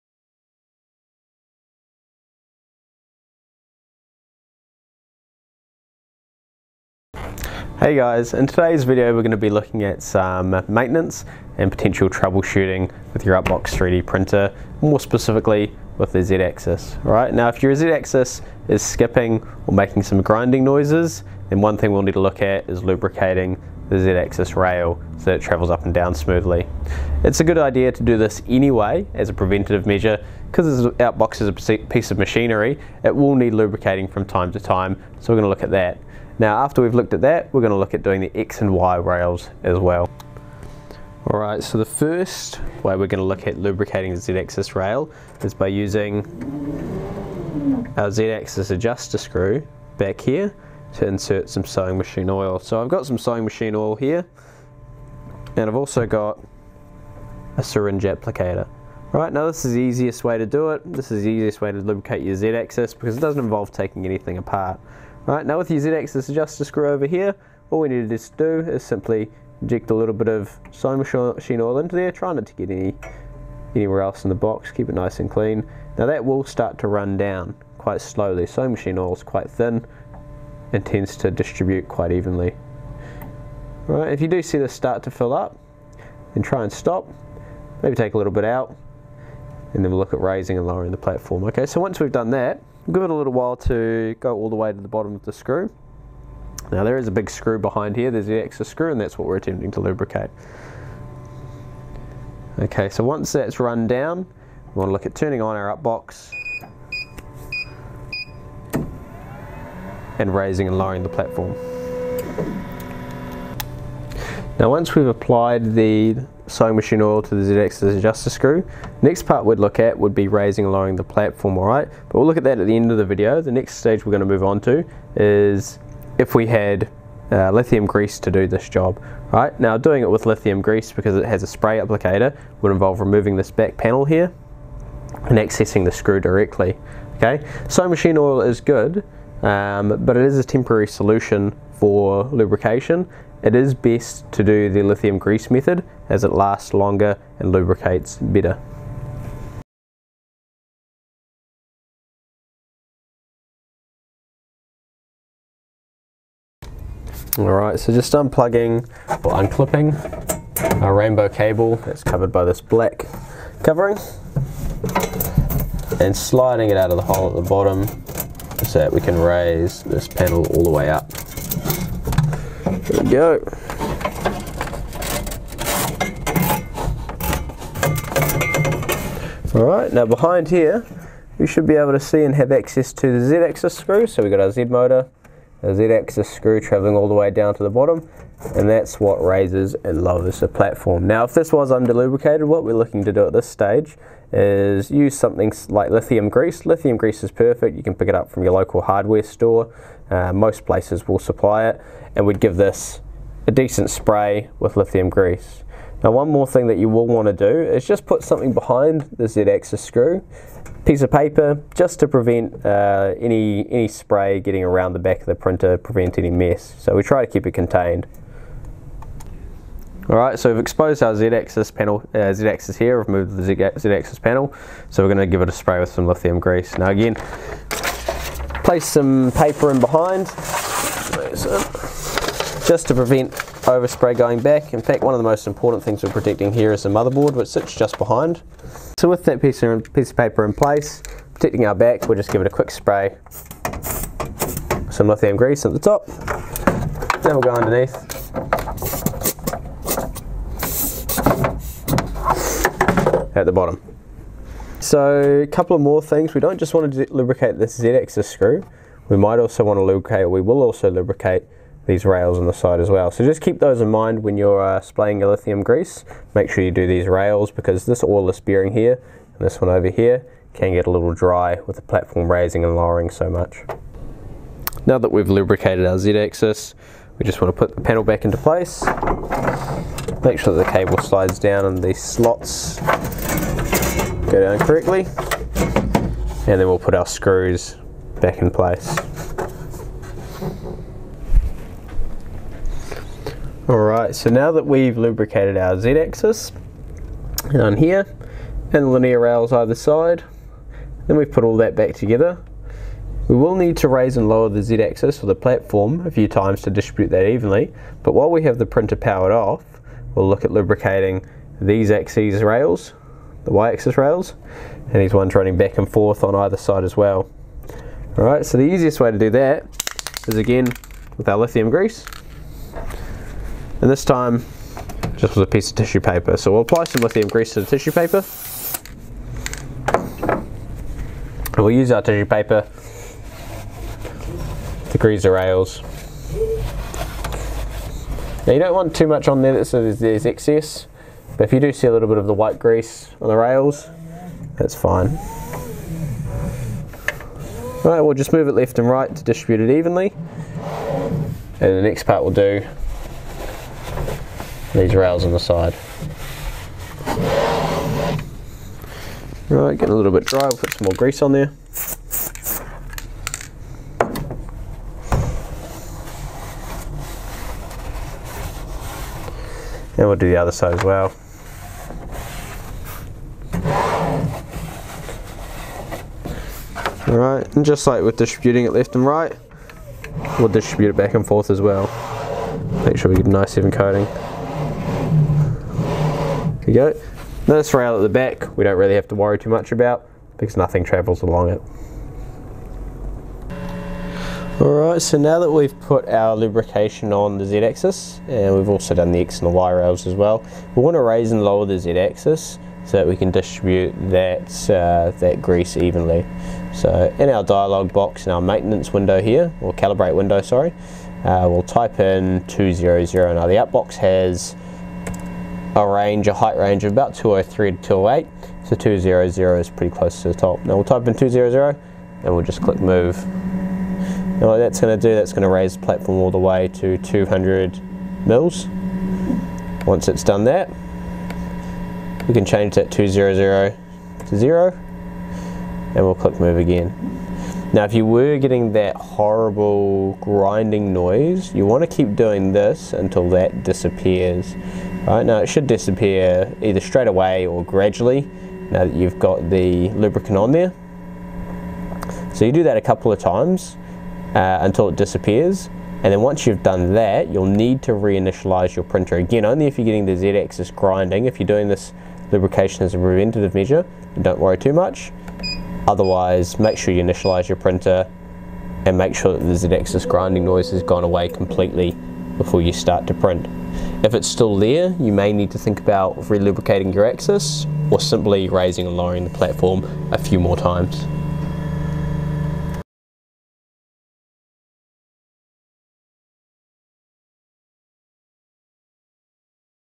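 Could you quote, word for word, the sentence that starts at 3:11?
Now if this was undelubricated what we're looking to do at this stage is use something like lithium grease.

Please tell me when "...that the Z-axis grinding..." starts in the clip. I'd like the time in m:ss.
7:49.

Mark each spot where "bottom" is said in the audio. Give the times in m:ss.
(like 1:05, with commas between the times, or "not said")
1:34, 2:47, 3:07, 4:13.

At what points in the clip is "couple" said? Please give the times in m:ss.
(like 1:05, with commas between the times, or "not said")
4:15, 7:32.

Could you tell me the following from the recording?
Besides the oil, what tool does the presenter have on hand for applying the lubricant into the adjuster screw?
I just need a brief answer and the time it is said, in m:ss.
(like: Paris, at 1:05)
syringe applicator, at 0:57.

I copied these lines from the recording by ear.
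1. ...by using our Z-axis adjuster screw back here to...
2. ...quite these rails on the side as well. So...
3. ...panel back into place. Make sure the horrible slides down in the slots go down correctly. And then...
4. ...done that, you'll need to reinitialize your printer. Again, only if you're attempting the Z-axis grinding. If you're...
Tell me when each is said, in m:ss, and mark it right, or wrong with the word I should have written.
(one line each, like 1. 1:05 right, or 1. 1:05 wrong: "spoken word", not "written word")
1. 0:45 right
2. 4:20 wrong: "lubricate", not "quite"
3. 4:37 wrong: "cable", not "horrible"
4. 7:36 wrong: "getting", not "attempting".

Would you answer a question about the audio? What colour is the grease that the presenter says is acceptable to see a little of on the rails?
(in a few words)
white.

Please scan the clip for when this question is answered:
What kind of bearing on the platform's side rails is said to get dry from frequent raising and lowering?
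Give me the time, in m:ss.
4:28.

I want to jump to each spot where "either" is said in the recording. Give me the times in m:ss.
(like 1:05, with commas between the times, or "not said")
4:59, 5:16, 7:26.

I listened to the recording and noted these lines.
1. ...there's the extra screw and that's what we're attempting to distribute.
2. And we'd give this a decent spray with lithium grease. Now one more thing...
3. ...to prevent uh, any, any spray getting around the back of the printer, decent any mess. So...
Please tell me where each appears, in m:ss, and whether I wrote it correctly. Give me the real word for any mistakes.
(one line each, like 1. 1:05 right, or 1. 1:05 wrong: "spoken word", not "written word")
1. 1:38 wrong: "lubricate", not "distribute"
2. 3:22 right
3. 3:31 wrong: "prevent", not "decent".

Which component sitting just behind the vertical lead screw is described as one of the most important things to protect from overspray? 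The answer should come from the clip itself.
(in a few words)
motherboard.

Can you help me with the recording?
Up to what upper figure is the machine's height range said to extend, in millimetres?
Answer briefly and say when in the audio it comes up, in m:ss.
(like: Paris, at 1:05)
208, at 6:57.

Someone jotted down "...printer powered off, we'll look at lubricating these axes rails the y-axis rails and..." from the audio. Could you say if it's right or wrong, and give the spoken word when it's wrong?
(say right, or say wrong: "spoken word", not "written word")
right.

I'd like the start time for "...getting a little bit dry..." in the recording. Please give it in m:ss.
5:59.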